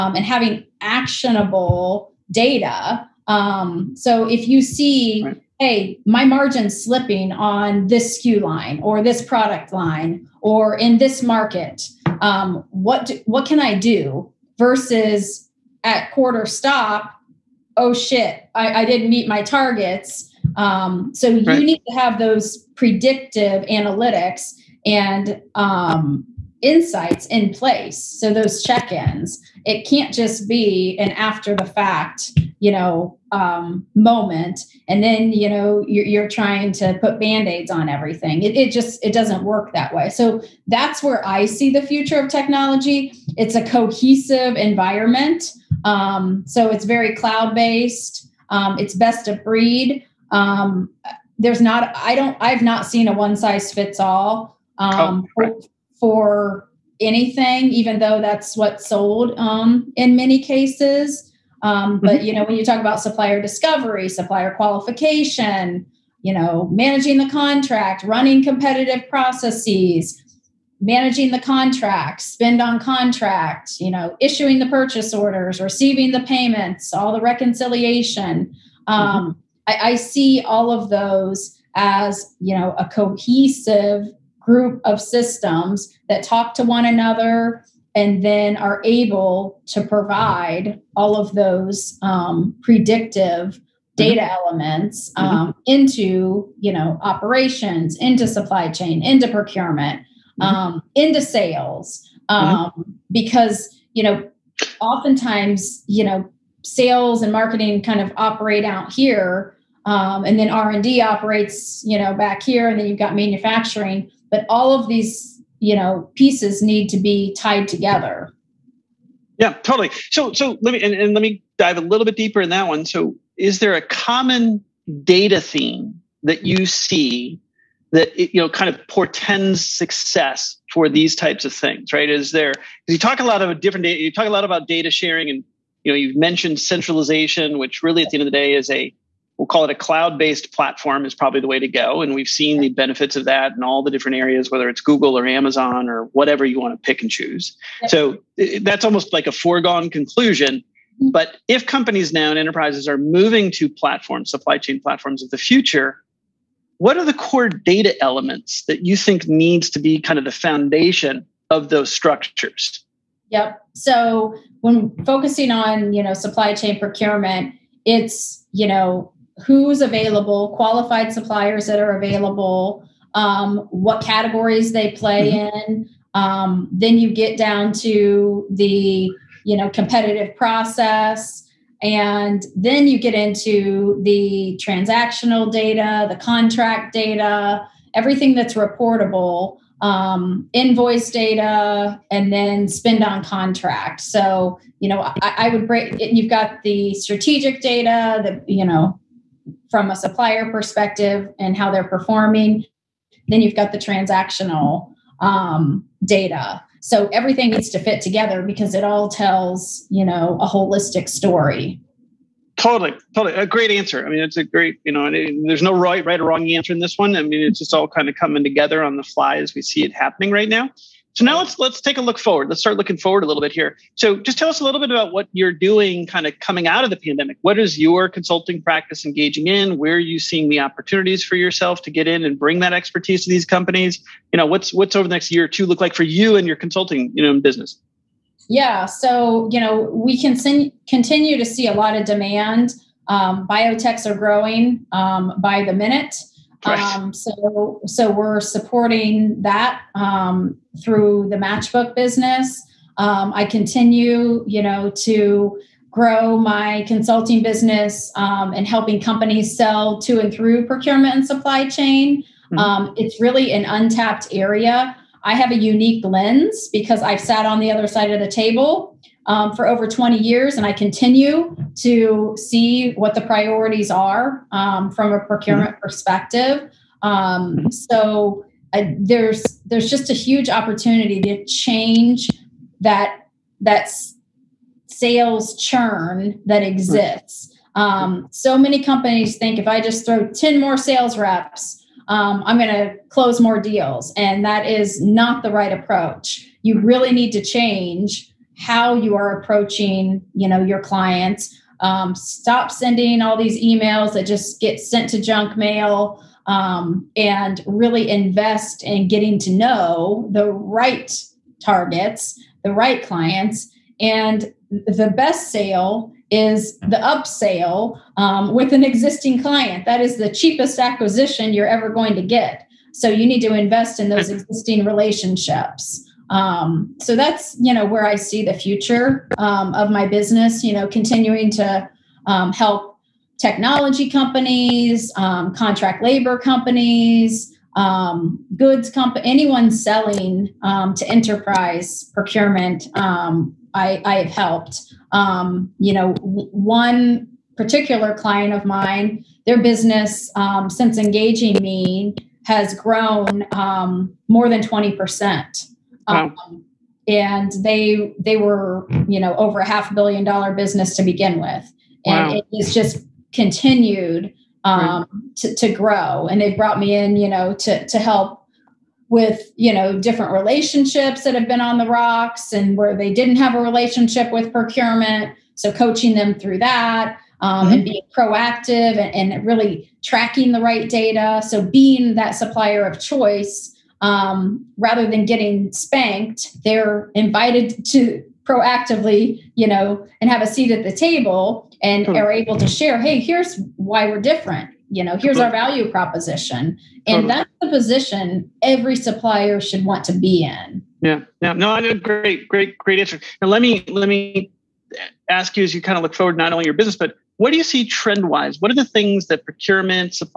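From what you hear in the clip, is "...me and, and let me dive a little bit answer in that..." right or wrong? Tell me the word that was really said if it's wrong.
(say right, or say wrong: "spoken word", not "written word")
wrong: "deeper", not "answer".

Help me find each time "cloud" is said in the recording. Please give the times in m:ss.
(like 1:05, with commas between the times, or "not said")
0:47, 2:19.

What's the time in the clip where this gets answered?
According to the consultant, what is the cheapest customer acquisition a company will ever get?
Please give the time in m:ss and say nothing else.
5:16.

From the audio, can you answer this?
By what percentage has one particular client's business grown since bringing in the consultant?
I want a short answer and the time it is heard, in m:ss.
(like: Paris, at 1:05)
More than 20%, at 5:54.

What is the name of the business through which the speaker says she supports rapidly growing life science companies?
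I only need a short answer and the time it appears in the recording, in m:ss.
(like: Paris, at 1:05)
Matchbook, at 4:11.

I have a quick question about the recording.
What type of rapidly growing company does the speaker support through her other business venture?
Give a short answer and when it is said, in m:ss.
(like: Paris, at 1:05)
Biotechs, at 4:03.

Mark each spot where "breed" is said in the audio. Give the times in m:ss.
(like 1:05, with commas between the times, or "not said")
0:49.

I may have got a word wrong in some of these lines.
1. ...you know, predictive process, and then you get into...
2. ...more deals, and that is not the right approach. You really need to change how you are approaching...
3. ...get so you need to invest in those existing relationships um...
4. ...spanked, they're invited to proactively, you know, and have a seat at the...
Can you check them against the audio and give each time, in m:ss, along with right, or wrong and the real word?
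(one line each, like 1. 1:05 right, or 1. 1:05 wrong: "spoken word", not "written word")
1. 2:59 wrong: "competitive", not "predictive"
2. 4:53 right
3. 5:22 right
4. 6:25 right.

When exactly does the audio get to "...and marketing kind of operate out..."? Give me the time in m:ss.
1:47.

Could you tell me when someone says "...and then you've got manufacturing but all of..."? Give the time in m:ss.
1:52.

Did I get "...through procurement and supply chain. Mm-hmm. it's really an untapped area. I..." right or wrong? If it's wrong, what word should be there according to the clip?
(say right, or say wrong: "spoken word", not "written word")
right.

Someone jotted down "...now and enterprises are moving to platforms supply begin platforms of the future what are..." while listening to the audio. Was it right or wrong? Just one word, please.
wrong.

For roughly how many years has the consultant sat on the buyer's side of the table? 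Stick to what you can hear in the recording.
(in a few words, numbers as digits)
Over 20 years.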